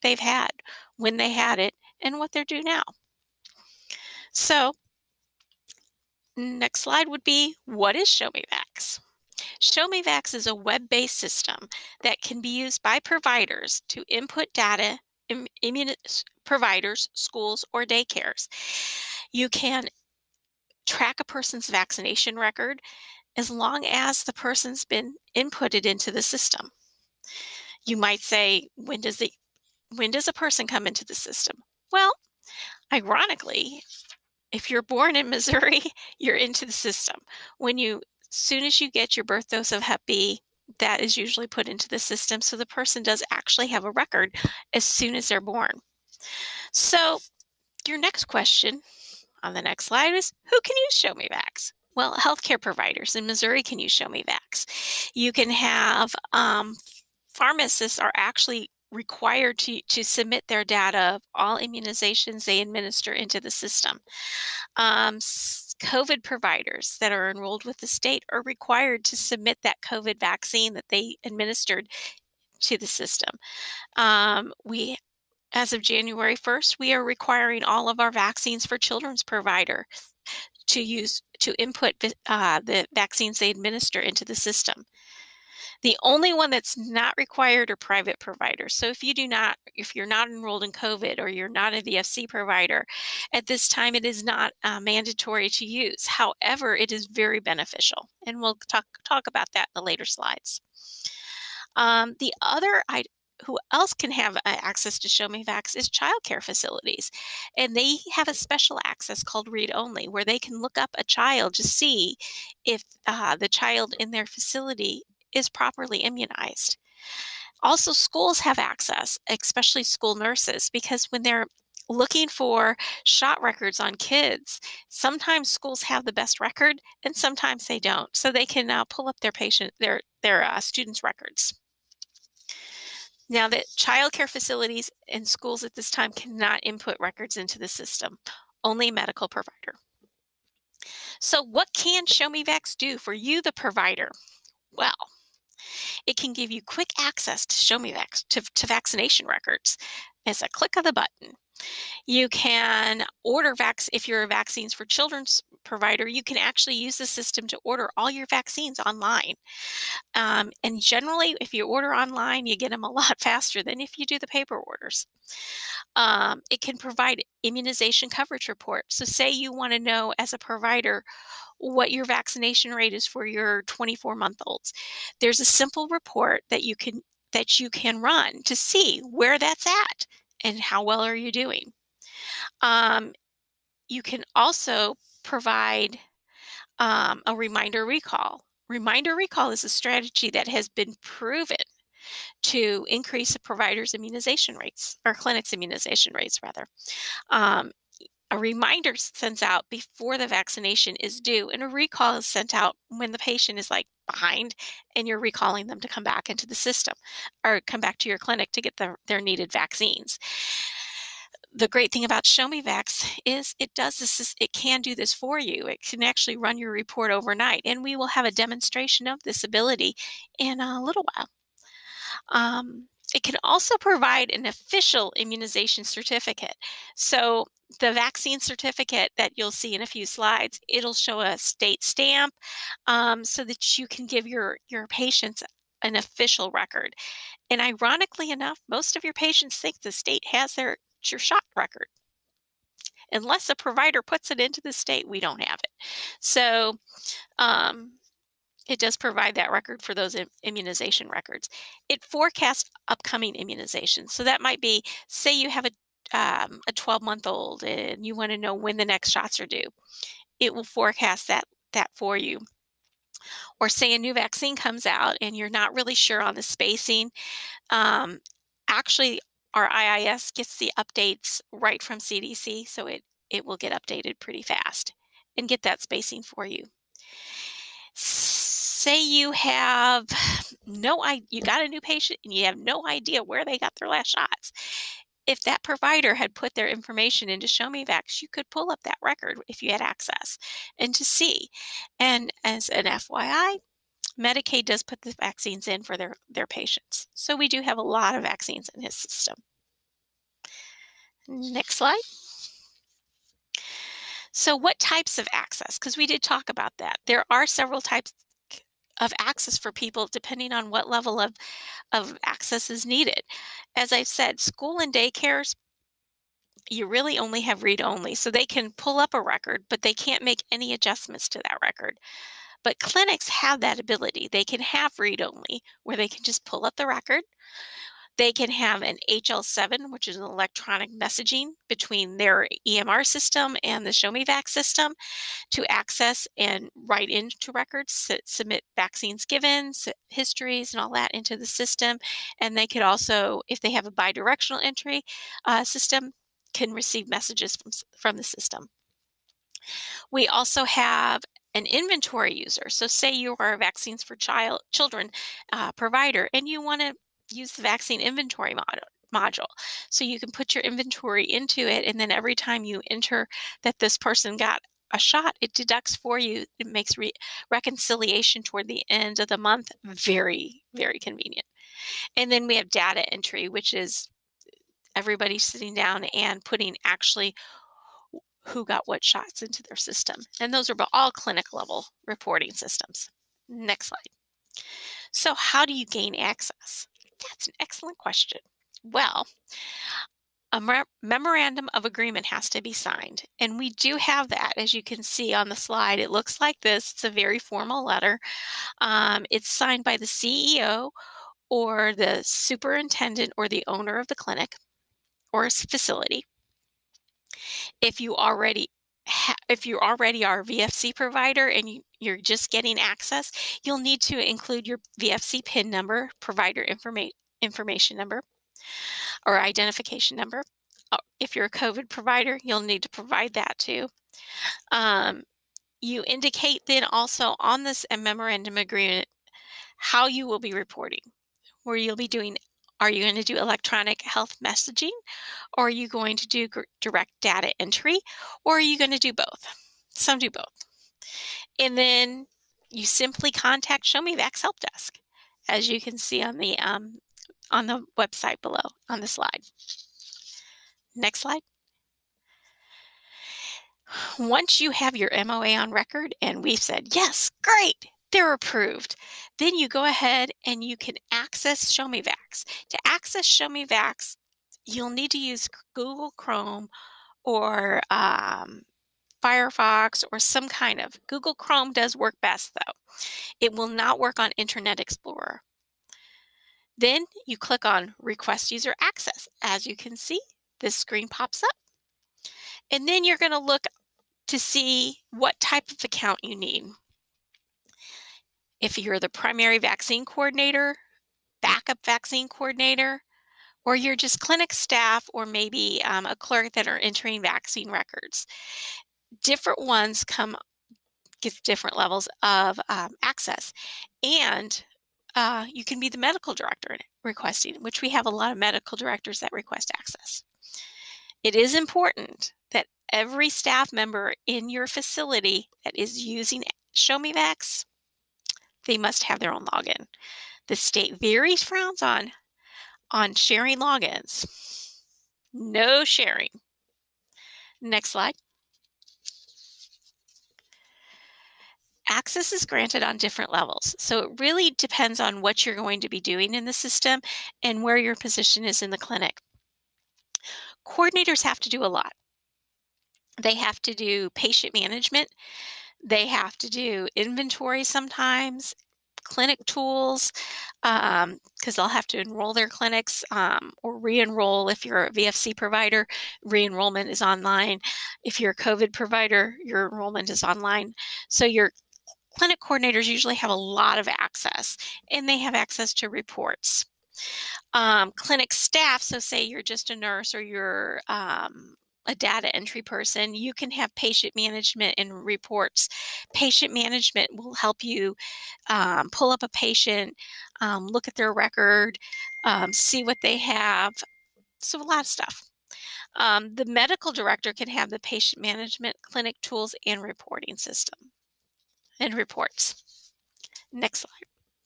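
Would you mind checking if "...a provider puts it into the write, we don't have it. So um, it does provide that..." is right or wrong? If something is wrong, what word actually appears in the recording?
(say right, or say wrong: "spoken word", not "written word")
wrong: "state", not "write".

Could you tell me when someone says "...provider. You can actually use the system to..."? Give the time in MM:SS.
02:35.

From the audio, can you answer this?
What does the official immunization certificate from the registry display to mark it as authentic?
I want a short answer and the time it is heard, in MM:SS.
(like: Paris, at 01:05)
a state stamp, at 03:51.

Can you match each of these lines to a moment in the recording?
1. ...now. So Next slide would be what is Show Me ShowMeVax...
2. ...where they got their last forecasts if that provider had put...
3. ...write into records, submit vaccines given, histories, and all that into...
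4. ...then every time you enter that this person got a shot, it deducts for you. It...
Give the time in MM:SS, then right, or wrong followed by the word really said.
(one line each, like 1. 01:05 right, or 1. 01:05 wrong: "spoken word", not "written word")
1. 00:02 right
2. 04:43 wrong: "shots", not "forecasts"
3. 05:36 right
4. 06:01 right.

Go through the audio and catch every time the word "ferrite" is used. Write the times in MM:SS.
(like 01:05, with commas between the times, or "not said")
not said.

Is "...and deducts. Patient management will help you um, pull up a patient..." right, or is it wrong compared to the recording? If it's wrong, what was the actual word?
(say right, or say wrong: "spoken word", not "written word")
wrong: "reports", not "deducts".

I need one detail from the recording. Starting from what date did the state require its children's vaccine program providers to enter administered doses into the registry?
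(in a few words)
January 1st.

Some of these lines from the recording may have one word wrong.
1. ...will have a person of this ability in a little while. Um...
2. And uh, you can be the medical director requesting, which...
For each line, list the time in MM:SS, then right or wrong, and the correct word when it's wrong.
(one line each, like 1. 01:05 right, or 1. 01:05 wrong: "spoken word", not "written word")
1. 03:37 wrong: "demonstration", not "person"
2. 08:24 right.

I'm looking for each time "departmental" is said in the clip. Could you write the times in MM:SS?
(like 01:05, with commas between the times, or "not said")
not said.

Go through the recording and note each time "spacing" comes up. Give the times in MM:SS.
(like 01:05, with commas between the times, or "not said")
04:26, 04:35.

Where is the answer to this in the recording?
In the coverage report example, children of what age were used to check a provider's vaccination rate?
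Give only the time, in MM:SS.
02:53.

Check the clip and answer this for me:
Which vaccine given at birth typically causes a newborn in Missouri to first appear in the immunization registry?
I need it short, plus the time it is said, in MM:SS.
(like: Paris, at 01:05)
Hep B, at 00:39.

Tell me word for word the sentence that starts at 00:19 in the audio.
You can track a person's vaccination record as long as the person's been inputted into the system.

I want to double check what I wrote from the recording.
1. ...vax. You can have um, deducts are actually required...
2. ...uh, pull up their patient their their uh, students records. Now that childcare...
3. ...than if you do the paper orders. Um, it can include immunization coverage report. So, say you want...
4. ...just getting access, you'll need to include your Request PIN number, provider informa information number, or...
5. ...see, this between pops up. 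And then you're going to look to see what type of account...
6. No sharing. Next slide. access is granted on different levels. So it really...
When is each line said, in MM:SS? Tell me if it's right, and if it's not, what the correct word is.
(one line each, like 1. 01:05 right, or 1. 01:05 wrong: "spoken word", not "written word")
1. 00:54 wrong: "pharmacists", not "deducts"
2. 02:08 right
3. 02:43 wrong: "provide", not "include"
4. 06:52 wrong: "VFC", not "Request"
5. 07:59 wrong: "screen", not "between"
6. 08:45 right.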